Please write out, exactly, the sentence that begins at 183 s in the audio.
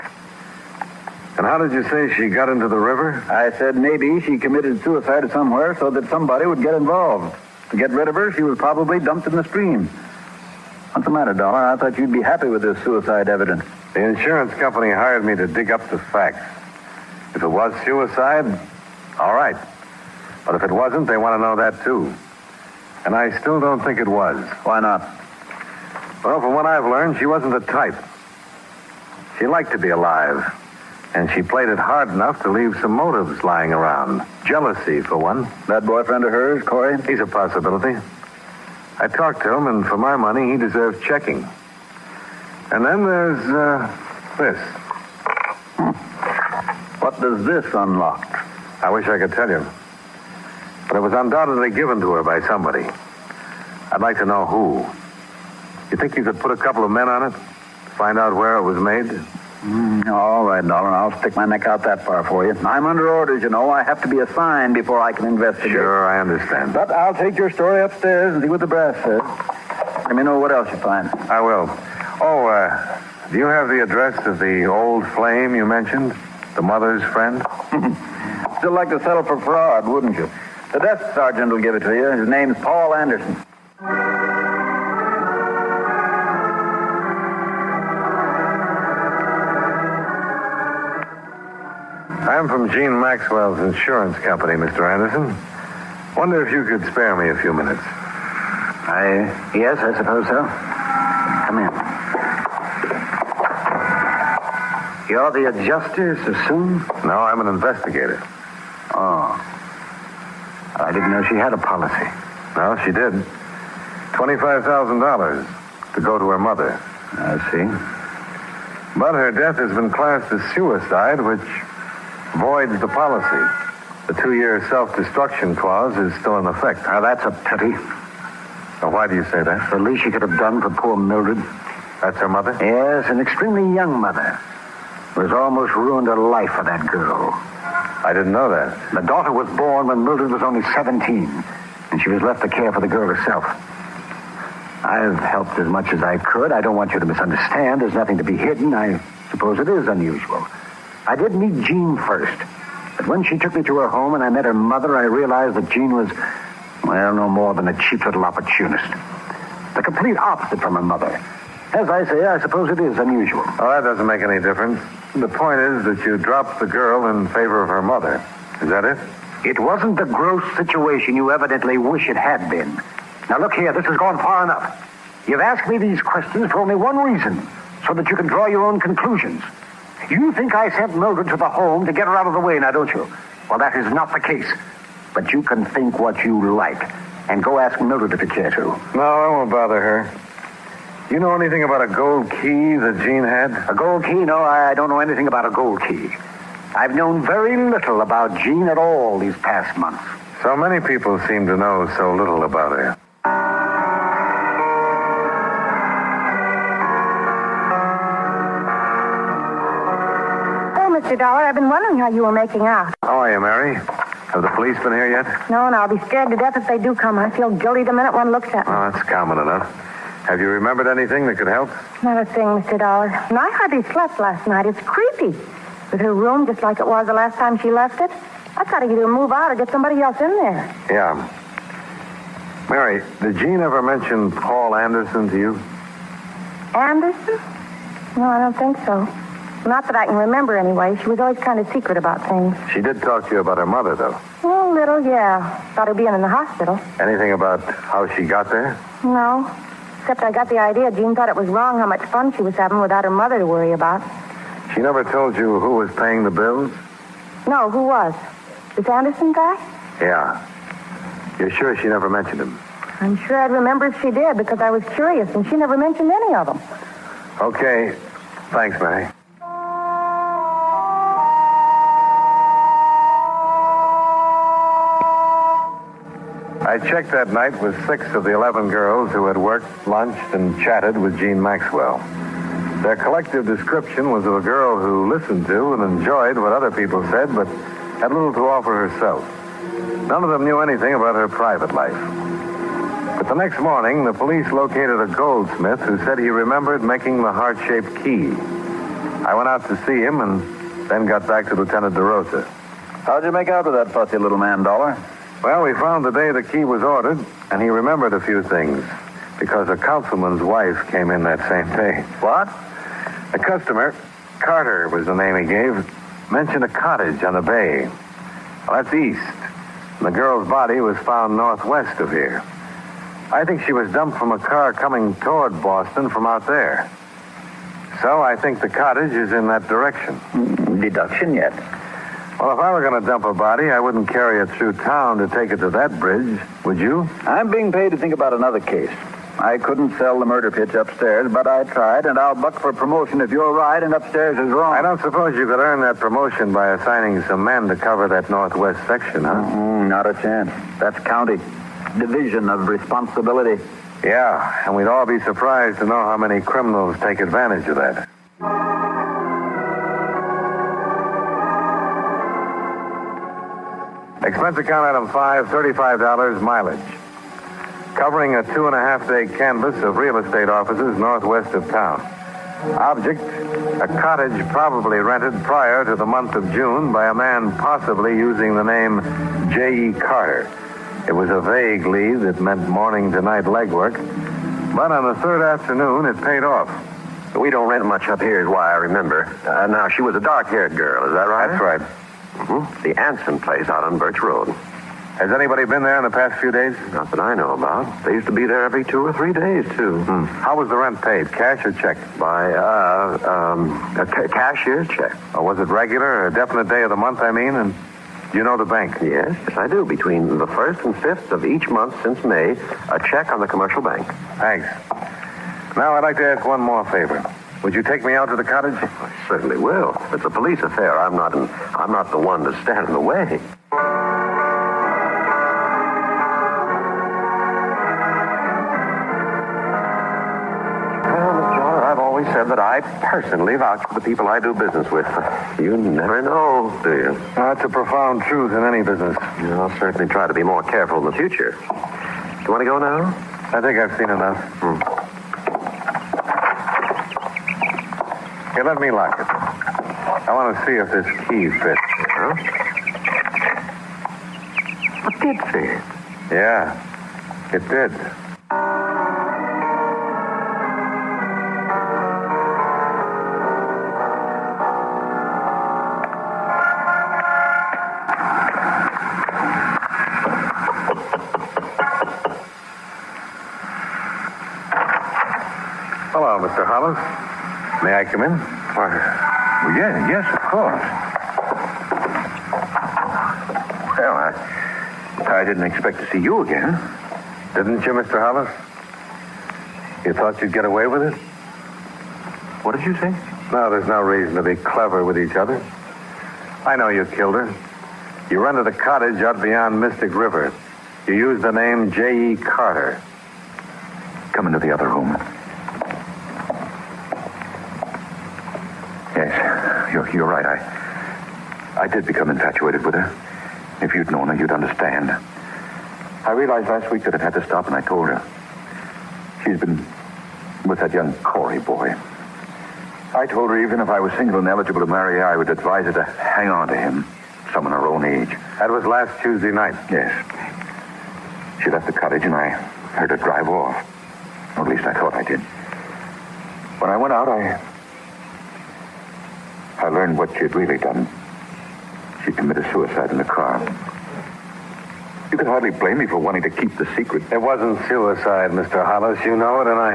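Well, that is not the case.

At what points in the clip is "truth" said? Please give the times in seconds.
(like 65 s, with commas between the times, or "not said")
438 s.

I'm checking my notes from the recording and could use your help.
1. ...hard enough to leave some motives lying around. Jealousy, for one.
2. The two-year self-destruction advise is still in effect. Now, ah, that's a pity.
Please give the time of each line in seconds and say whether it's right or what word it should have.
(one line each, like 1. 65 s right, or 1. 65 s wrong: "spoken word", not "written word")
1. 31 s right
2. 124 s wrong: "clause", not "advise".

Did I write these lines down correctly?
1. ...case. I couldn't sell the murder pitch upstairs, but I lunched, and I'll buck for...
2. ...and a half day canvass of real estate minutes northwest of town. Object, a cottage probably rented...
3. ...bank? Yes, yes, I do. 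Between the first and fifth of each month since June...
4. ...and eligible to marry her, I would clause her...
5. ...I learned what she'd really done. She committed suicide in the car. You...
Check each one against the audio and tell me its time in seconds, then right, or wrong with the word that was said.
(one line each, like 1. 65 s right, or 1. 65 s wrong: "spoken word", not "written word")
1. 338 s wrong: "tried", not "lunched"
2. 368 s wrong: "offices", not "minutes"
3. 408 s wrong: "May", not "June"
4. 524 s wrong: "advise", not "clause"
5. 539 s right.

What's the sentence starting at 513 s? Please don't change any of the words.
If you'd known her, you'd understand.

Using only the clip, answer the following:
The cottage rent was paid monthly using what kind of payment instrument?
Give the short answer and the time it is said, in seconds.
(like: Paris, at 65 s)
Cashier's check, at 404 s.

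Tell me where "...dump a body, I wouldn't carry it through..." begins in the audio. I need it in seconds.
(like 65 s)
333 s.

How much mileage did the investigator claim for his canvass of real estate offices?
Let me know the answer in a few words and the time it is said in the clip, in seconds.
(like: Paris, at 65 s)
$35, at 365 s.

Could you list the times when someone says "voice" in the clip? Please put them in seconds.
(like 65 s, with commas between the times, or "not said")
not said.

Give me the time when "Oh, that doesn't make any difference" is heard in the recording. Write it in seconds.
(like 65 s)
163 s.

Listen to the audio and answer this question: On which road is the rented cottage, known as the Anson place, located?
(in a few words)
Birch Road.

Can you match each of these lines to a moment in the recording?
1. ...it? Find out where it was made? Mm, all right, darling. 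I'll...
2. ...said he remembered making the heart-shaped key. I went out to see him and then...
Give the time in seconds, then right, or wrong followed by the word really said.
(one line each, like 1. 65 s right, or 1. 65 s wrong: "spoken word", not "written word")
1. 57 s right
2. 295 s right.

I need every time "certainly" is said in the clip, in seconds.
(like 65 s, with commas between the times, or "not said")
419 s, 439 s.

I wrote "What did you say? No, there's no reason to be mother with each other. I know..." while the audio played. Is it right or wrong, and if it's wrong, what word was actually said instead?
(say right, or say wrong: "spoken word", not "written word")
wrong: "clever", not "mother".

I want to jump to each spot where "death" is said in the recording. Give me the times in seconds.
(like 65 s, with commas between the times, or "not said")
119 s, 216 s.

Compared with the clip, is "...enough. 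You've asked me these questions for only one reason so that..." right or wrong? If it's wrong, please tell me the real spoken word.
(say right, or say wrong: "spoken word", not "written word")
right.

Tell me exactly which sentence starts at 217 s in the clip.
I feel guilty the minute one looks at me.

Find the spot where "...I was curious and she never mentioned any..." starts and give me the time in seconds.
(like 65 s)
264 s.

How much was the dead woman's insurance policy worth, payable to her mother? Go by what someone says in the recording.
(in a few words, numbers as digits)
$25,000.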